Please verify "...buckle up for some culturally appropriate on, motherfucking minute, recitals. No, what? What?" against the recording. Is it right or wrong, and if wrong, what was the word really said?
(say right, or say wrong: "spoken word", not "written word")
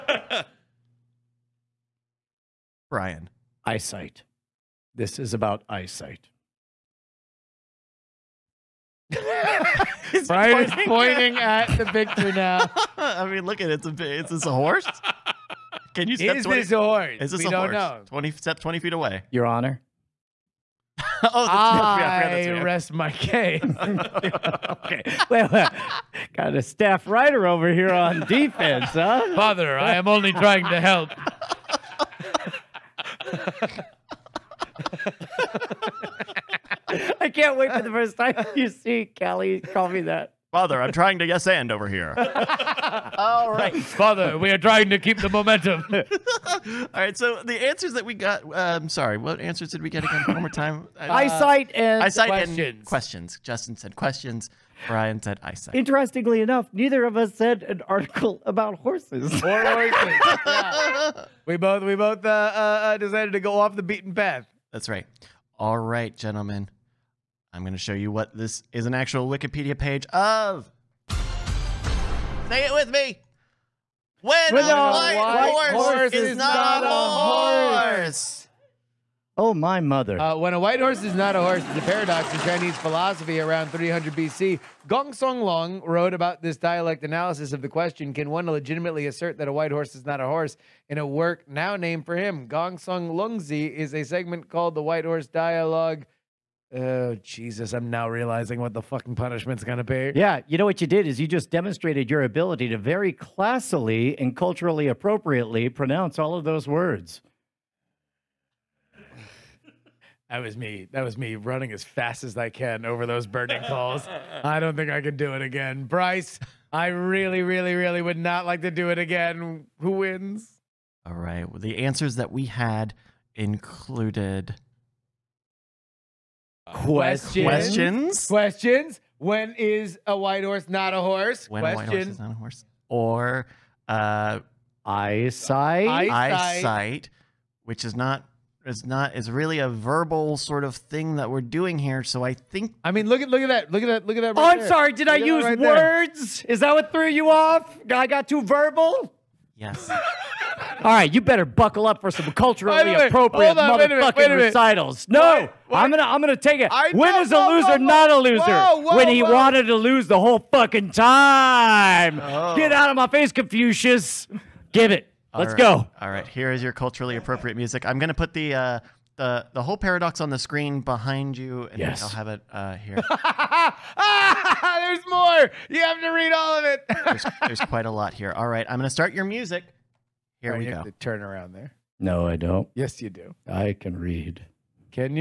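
right.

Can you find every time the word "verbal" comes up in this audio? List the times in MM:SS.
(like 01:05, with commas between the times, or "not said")
02:19, 02:28.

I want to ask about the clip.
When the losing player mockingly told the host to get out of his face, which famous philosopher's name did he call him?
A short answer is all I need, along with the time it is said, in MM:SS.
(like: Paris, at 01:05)
Confucius, at 02:43.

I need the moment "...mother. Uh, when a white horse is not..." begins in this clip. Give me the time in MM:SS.
01:19.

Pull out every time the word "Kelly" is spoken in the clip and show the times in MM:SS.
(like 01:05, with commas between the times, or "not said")
00:39.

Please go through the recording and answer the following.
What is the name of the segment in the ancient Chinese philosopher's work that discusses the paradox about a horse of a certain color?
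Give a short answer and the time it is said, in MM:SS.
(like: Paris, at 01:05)
The White Horse Dialogue, at 01:34.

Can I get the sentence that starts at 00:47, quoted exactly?
So the answers that we got, Um, I'm sorry, what answers did we get again?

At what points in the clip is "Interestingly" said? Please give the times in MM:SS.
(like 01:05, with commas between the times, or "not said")
00:55.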